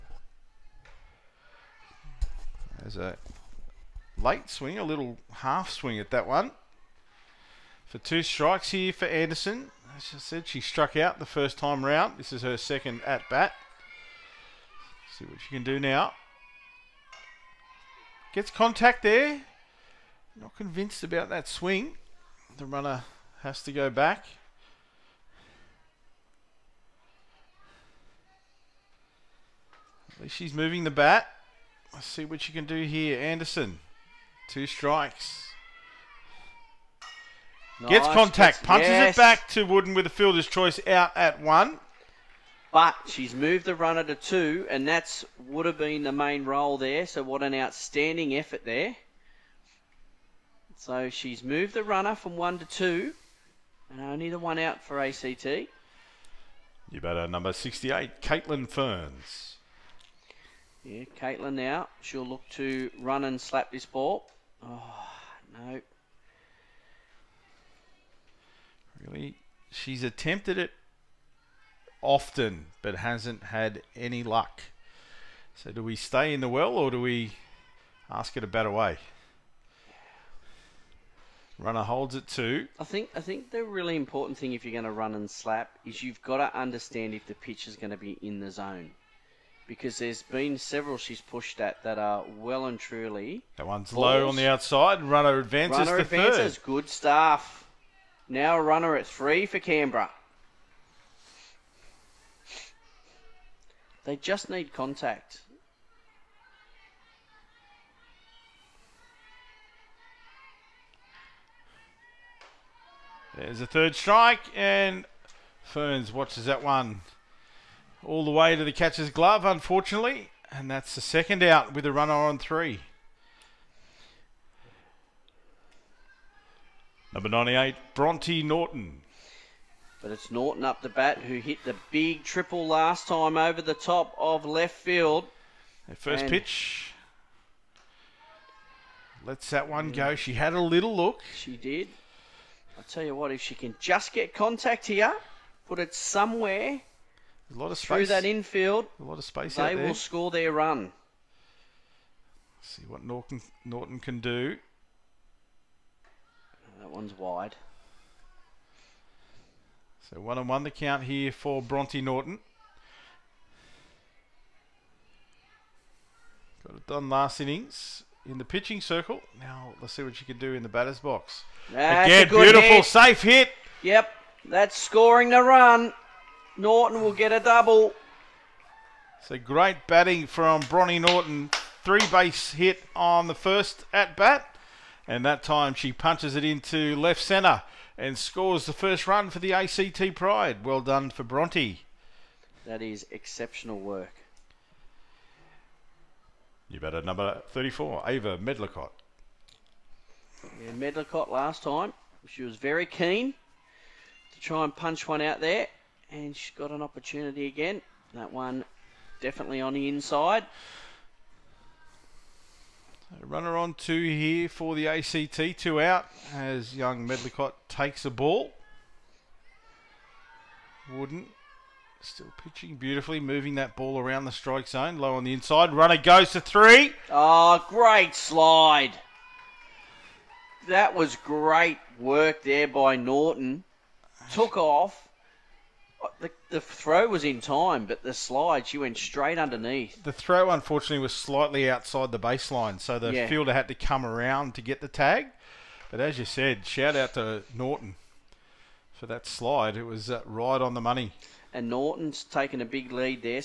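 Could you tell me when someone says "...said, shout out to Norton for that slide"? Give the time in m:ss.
4:06.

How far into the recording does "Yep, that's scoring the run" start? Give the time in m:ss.
2:53.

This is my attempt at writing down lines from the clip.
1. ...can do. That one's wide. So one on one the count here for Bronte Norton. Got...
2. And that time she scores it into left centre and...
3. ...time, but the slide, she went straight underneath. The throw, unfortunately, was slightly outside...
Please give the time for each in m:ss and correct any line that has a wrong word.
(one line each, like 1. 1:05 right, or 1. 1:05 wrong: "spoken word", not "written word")
1. 2:33 right
2. 3:05 wrong: "punches", not "scores"
3. 3:57 right.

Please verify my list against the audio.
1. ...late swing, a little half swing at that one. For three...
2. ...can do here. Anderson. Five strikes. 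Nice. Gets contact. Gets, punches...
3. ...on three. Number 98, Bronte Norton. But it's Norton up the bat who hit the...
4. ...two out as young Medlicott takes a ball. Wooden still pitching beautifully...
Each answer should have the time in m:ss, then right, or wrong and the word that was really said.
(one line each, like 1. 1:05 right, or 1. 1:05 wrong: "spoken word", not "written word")
1. 0:04 wrong: "two", not "three"
2. 0:32 wrong: "Two", not "Five"
3. 2:02 right
4. 3:35 right.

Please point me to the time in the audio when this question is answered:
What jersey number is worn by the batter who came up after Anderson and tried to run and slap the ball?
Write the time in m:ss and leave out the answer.
0:57.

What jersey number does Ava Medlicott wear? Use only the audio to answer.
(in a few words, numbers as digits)
34.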